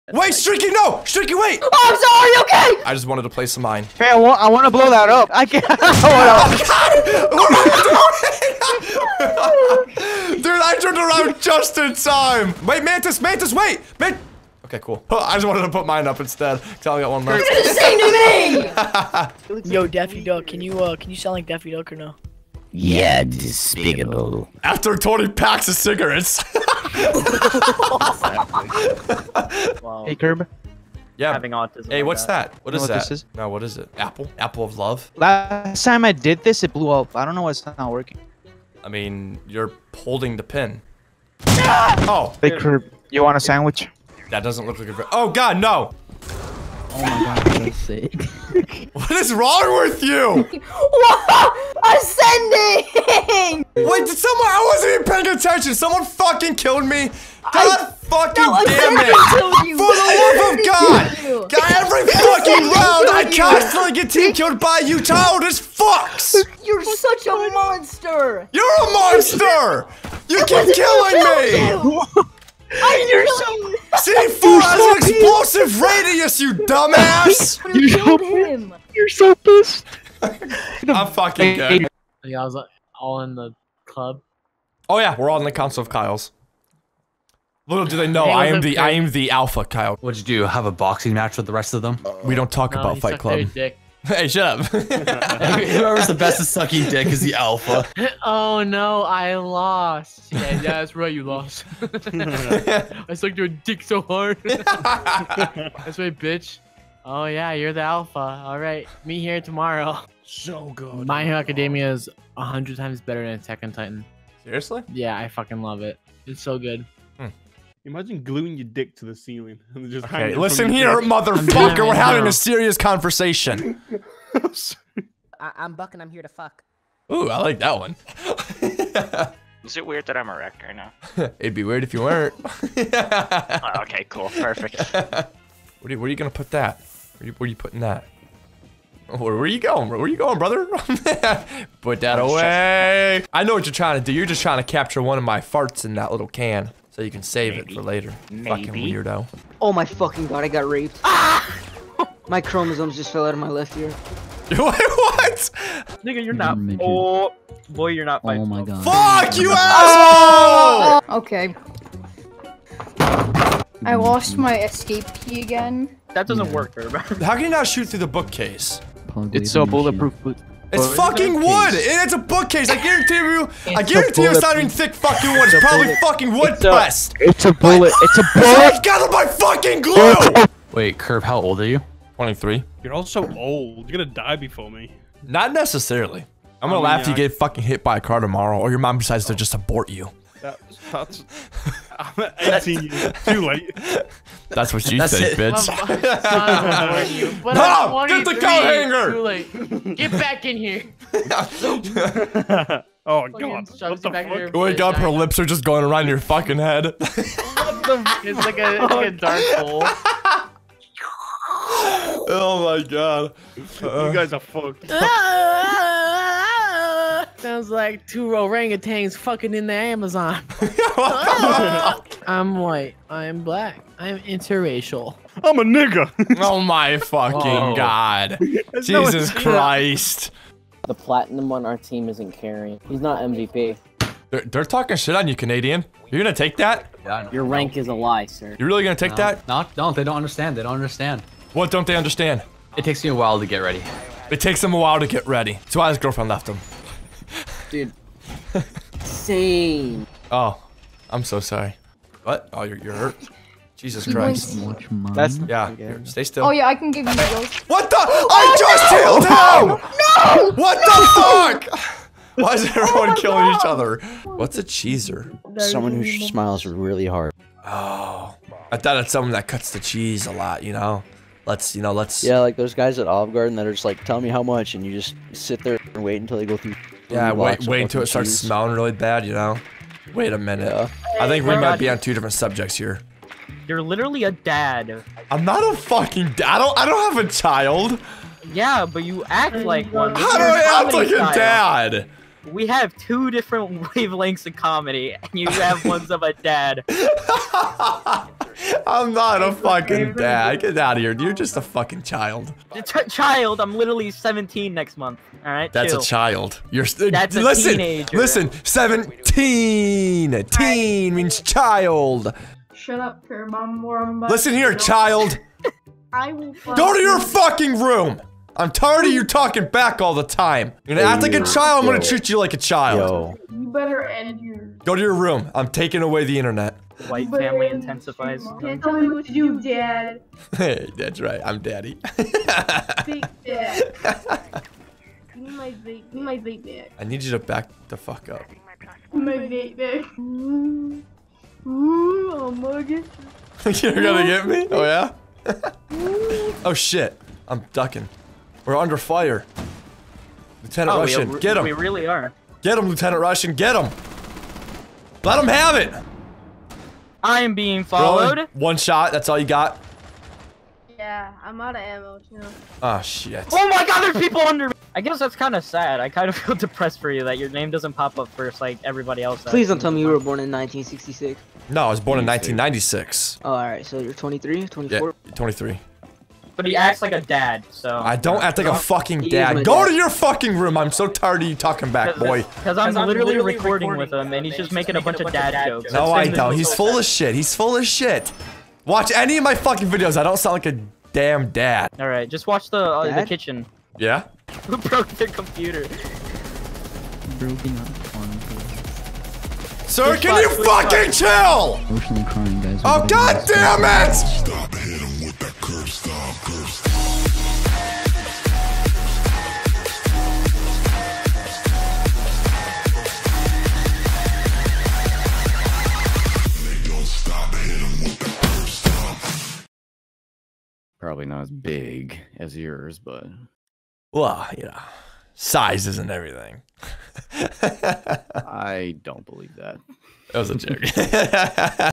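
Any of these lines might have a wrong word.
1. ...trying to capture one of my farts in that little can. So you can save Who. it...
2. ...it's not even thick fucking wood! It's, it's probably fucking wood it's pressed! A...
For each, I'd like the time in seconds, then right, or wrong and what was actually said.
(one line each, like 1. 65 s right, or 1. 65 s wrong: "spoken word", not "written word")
1. 144 s wrong: "Maybe", not "Who"
2. 174 s right.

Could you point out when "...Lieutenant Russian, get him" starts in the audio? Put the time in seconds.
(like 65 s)
352 s.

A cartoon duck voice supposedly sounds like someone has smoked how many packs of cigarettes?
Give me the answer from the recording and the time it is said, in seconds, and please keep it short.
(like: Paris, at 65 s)
20, at 24 s.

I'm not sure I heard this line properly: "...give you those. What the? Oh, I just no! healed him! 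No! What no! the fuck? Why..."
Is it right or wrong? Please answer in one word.
right.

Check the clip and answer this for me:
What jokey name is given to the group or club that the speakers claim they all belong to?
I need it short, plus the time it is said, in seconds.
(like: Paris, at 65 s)
Council of Kyles, at 85 s.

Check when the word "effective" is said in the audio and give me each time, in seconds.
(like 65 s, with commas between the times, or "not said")
not said.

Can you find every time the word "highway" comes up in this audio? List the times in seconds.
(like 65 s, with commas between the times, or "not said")
not said.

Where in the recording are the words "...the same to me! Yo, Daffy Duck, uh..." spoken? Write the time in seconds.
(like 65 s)
17 s.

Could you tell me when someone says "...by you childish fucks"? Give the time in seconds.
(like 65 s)
64 s.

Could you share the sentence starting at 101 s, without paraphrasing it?
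I sucked your dick so hard.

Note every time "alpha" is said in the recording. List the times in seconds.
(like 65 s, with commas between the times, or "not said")
89 s, 97 s, 107 s.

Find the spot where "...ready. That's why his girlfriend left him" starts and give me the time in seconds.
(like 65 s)
245 s.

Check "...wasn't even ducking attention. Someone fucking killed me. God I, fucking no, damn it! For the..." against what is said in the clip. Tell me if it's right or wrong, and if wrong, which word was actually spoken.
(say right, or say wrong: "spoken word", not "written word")
wrong: "paying", not "ducking".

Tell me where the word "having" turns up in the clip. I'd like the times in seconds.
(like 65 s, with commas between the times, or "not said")
31 s, 121 s.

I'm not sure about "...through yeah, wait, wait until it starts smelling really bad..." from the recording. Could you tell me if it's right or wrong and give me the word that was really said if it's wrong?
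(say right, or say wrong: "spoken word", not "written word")
right.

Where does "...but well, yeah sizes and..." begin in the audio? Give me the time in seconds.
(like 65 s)
422 s.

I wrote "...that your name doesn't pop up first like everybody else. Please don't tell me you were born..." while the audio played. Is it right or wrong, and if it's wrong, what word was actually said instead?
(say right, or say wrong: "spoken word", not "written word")
right.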